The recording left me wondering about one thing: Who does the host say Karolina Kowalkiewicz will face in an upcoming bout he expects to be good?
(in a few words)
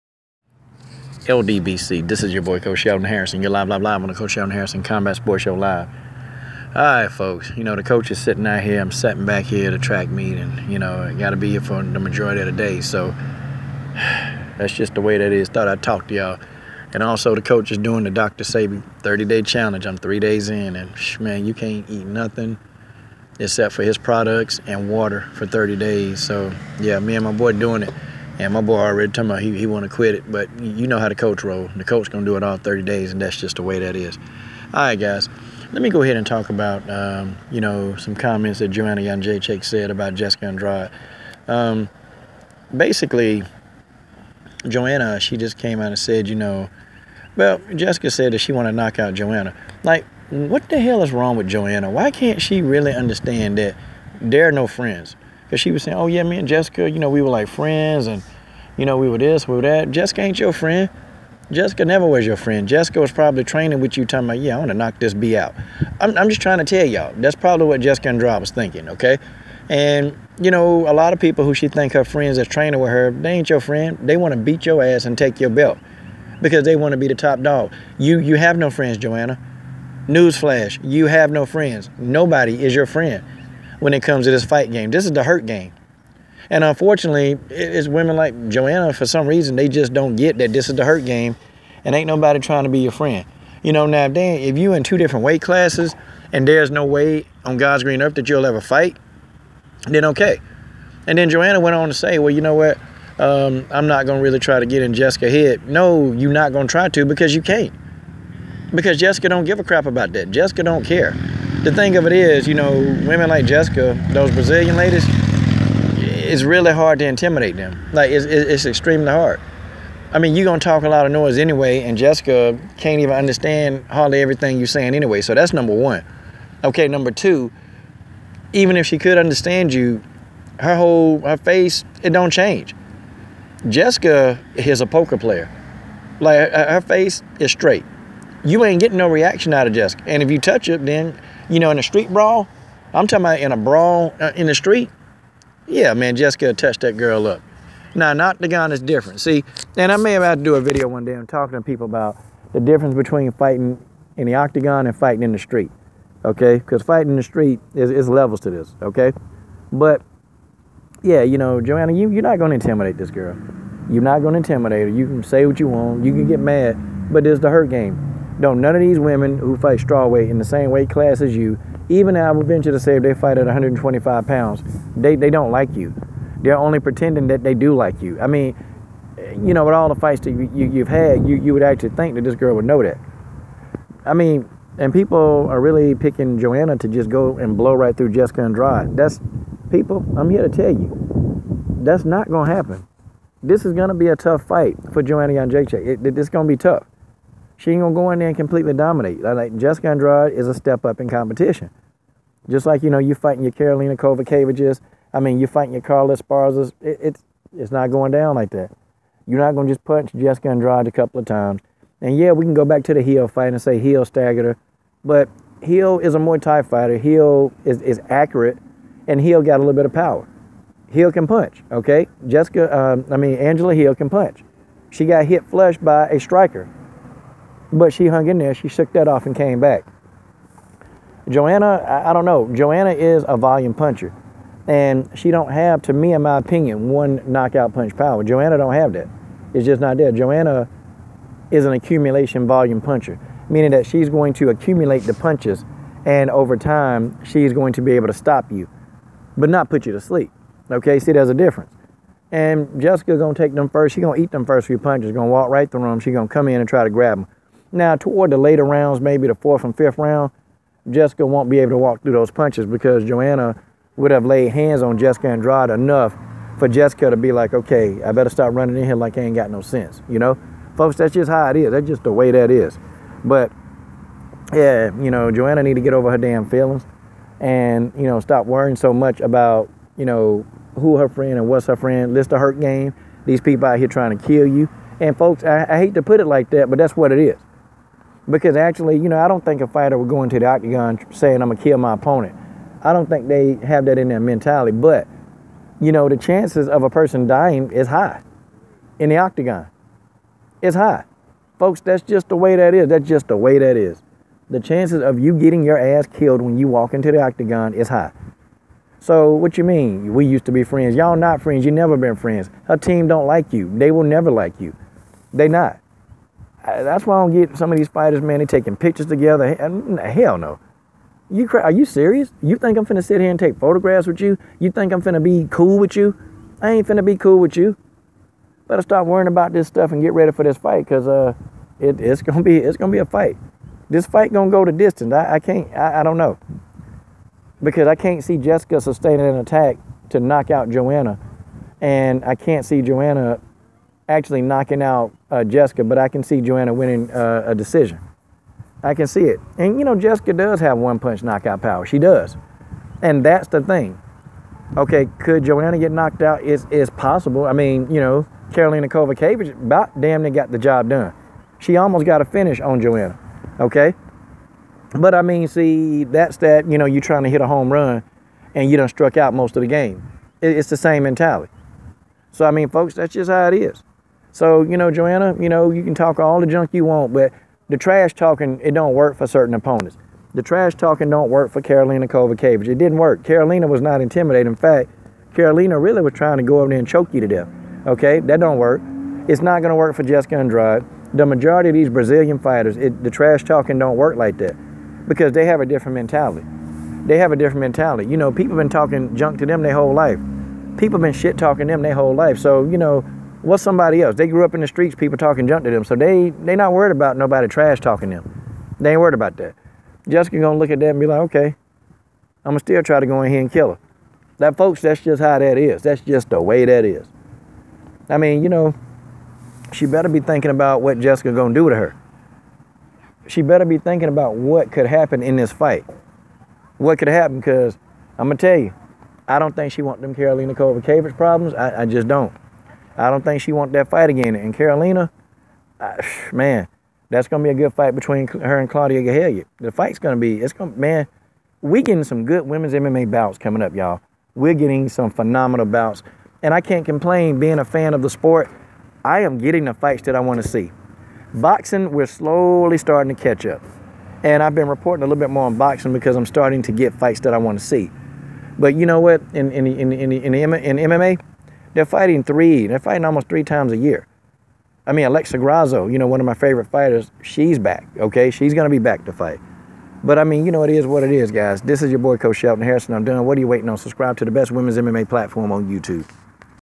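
Claudia Gadelha.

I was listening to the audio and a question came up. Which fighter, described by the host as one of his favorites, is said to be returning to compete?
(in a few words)
Alexa Grasso.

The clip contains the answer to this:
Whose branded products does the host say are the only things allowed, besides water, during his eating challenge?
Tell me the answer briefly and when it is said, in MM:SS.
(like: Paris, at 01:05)
Dr. Sebi, at 00:18.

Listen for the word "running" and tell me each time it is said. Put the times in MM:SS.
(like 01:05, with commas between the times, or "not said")
04:28.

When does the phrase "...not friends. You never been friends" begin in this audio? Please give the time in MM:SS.
05:11.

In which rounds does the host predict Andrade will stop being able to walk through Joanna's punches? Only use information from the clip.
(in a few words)
Fourth and fifth.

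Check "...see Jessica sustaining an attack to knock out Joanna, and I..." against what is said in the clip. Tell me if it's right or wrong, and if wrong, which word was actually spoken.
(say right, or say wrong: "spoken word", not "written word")
right.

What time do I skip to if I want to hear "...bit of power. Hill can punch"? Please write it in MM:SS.
03:39.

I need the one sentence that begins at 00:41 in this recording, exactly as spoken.
Um, basically, Joanna, she just came out and said, you know, well, Jessica said that she want to knock out Joanna.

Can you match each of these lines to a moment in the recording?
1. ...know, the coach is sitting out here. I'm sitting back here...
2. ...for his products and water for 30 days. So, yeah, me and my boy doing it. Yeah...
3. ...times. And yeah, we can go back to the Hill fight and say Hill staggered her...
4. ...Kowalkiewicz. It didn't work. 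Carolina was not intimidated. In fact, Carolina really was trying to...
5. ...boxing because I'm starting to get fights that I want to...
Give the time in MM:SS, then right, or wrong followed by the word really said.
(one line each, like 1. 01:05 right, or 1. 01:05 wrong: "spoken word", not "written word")
1. 00:07 right
2. 00:23 right
3. 03:31 right
4. 06:22 right
5. 07:35 right.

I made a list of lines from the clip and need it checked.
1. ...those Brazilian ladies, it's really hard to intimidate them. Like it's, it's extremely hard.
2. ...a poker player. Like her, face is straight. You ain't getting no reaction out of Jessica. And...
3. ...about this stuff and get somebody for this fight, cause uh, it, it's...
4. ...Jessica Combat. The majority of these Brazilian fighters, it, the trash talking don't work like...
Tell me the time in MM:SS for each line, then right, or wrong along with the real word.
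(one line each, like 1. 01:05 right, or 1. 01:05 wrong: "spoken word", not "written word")
1. 01:54 right
2. 02:14 right
3. 05:29 wrong: "ready", not "somebody"
4. 06:30 wrong: "Andrade", not "Combat".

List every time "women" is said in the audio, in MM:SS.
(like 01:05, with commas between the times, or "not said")
01:27, 01:53, 02:48, 07:22, 07:54.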